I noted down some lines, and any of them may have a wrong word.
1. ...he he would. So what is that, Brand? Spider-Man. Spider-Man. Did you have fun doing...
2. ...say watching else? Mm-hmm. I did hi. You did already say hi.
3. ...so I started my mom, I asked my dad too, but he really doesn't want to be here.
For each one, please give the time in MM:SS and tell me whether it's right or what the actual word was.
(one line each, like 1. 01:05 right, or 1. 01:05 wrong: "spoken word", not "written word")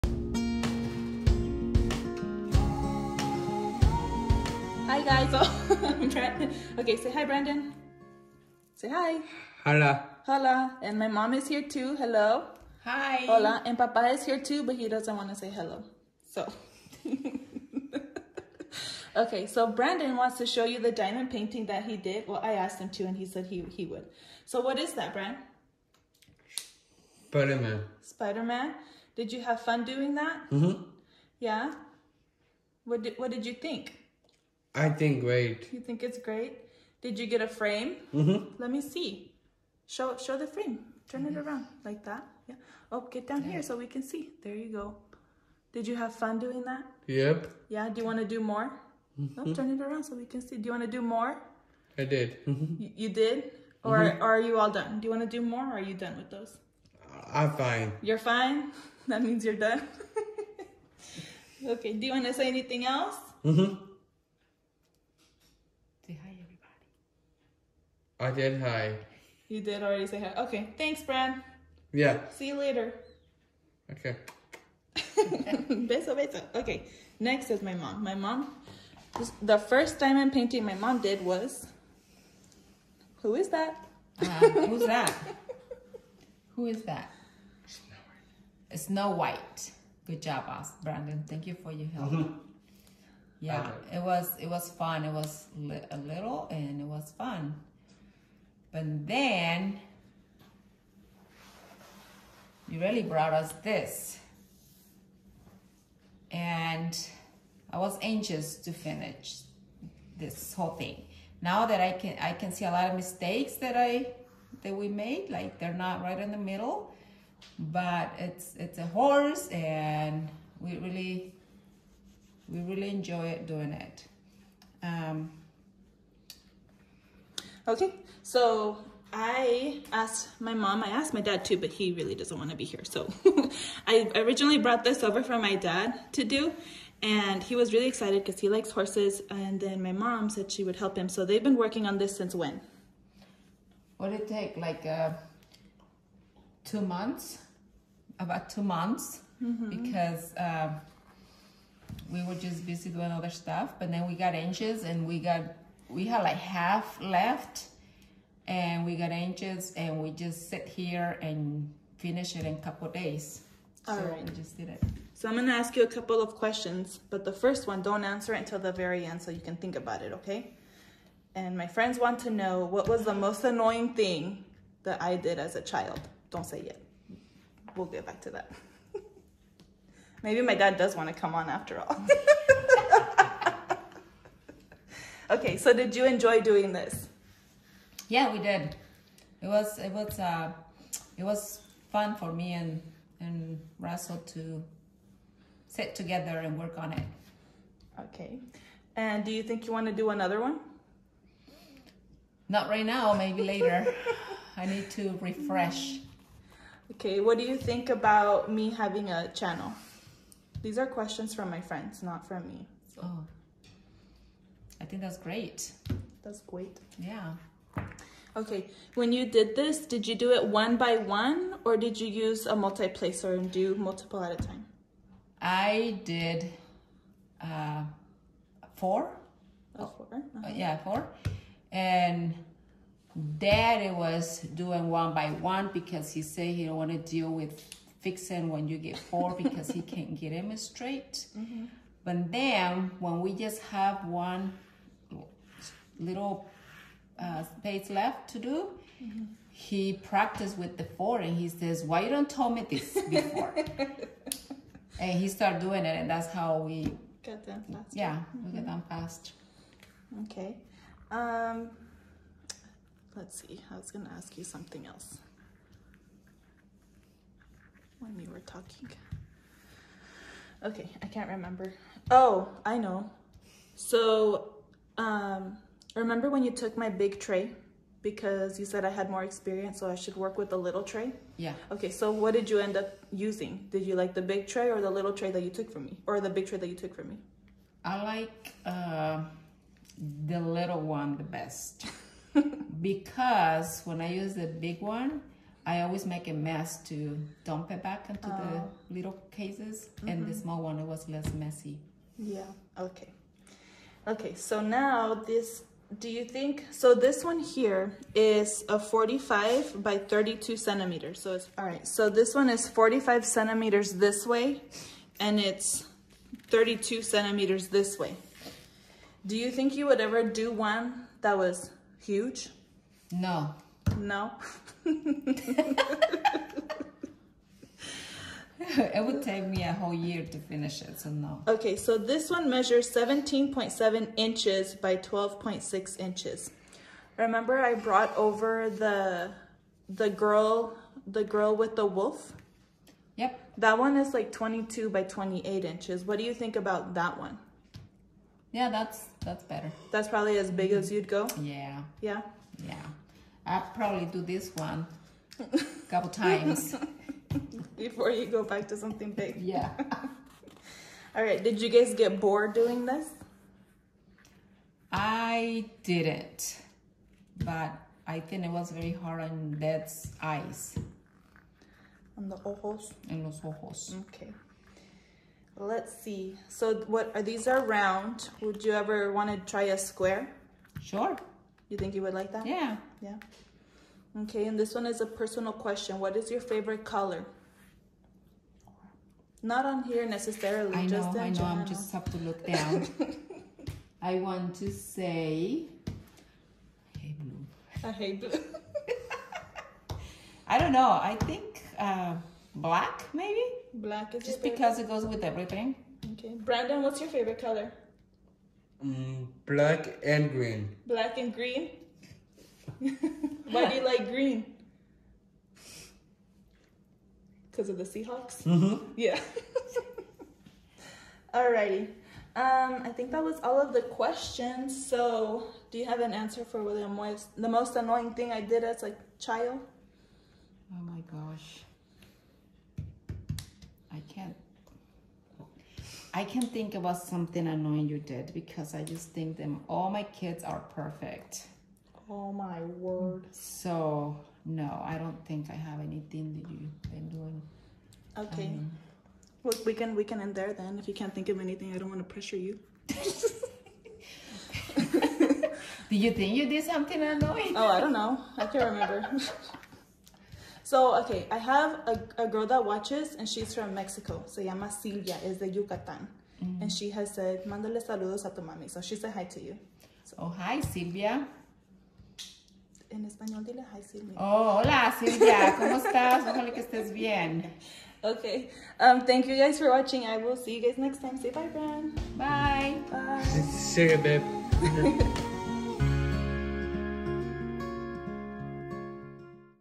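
1. 00:23 right
2. 01:02 wrong: "anything", not "watching"
3. 02:08 wrong: "asked", not "started".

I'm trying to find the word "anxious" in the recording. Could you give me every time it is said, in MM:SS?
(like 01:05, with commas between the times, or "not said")
01:48, 02:34.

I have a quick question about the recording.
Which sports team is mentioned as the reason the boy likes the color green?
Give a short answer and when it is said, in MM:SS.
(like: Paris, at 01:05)
Seahawks, at 06:57.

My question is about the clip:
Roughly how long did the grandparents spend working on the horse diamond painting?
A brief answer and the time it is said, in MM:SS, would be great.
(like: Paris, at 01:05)
About two months, at 02:28.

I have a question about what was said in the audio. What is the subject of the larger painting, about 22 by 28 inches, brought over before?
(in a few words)
Girl with the wolf.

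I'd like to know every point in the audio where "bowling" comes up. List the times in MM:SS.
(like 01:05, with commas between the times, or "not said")
not said.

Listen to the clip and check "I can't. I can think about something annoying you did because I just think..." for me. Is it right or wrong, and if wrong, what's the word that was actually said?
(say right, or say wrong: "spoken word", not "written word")
right.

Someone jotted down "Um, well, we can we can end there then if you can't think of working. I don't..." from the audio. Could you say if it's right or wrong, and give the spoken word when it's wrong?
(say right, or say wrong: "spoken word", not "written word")
wrong: "anything", not "working".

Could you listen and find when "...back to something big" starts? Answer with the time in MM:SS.
05:58.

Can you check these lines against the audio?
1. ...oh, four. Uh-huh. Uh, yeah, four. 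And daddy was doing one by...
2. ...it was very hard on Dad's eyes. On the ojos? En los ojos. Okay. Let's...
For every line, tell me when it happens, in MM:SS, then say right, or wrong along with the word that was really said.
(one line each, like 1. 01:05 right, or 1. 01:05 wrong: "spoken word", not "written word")
1. 03:48 right
2. 06:08 right.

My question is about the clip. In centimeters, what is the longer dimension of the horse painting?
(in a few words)
45.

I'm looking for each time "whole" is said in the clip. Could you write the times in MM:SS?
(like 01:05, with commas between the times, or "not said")
01:50, 05:29.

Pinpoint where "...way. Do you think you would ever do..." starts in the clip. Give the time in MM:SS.
05:17.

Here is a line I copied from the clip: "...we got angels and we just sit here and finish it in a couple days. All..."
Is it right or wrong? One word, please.
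right.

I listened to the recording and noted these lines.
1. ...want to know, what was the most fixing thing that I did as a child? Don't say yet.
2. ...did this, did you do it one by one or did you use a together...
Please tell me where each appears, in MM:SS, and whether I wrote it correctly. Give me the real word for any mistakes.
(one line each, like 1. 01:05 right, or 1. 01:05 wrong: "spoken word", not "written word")
1. 02:51 wrong: "annoying", not "fixing"
2. 03:39 wrong: "multiplacer", not "together".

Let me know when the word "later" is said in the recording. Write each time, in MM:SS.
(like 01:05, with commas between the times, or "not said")
01:12, 03:23.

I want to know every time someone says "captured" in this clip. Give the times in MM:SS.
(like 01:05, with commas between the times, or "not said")
not said.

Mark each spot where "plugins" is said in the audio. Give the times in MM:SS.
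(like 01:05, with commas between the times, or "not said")
not said.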